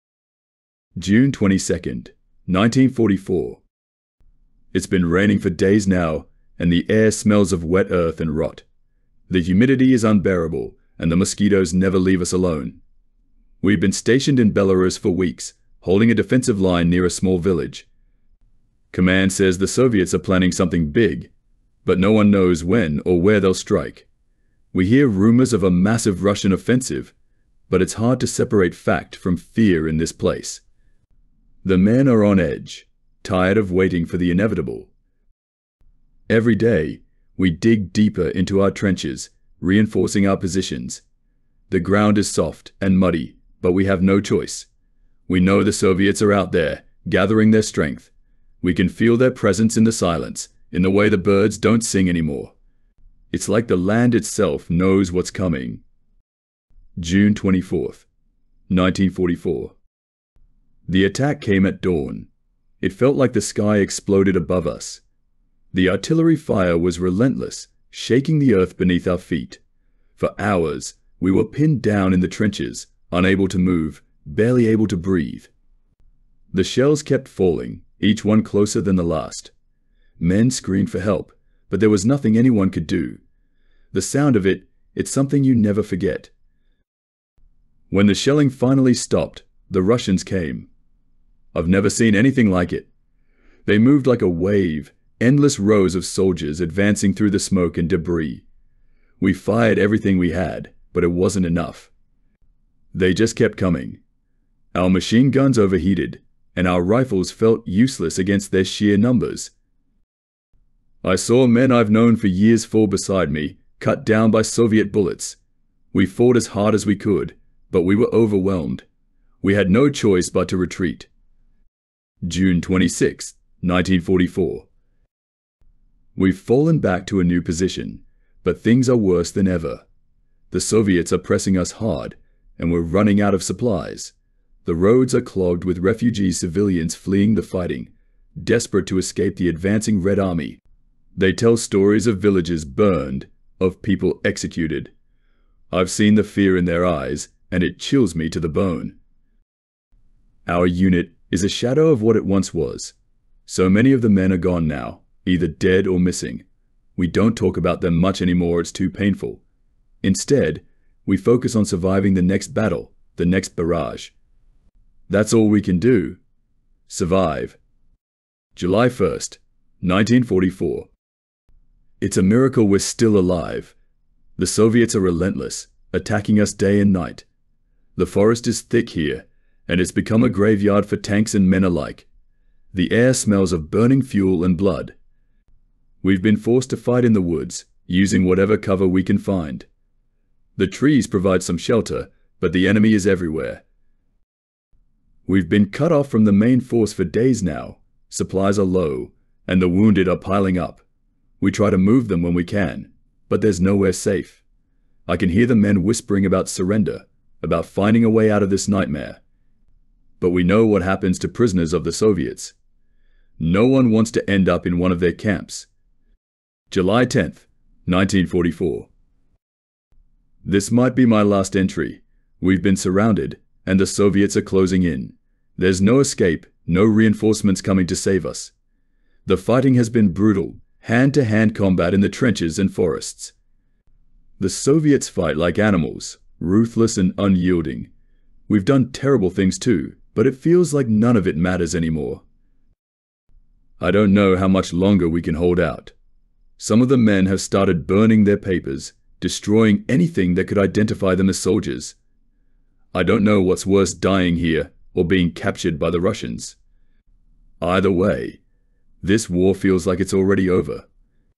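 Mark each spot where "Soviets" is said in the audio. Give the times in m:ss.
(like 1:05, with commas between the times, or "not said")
0:19, 0:45, 1:54, 2:10, 2:54, 3:31, 3:43, 3:54.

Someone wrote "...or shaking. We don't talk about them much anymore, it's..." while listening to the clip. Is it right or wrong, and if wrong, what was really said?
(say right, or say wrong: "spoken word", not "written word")
wrong: "missing", not "shaking".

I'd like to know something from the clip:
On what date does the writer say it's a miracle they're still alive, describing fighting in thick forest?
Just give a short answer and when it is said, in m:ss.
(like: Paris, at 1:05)
July 1st, 1944, at 2:48.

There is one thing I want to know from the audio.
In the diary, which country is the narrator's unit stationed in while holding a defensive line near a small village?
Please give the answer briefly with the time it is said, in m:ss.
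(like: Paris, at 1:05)
Belarus, at 0:14.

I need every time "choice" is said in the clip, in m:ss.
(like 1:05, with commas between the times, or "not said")
0:44, 1:59.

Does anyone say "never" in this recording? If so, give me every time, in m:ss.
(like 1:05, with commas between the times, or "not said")
0:11, 1:25, 1:31.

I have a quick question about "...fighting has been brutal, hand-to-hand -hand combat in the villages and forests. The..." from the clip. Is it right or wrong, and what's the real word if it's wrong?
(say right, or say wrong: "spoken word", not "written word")
wrong: "trenches", not "villages".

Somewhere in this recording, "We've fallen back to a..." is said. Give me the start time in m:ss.
2:06.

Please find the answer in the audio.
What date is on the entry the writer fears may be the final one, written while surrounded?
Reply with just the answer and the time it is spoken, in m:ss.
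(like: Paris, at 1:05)
July 10th, 1944, at 3:36.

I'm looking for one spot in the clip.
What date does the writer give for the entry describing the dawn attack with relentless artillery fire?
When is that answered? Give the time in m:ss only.
0:56.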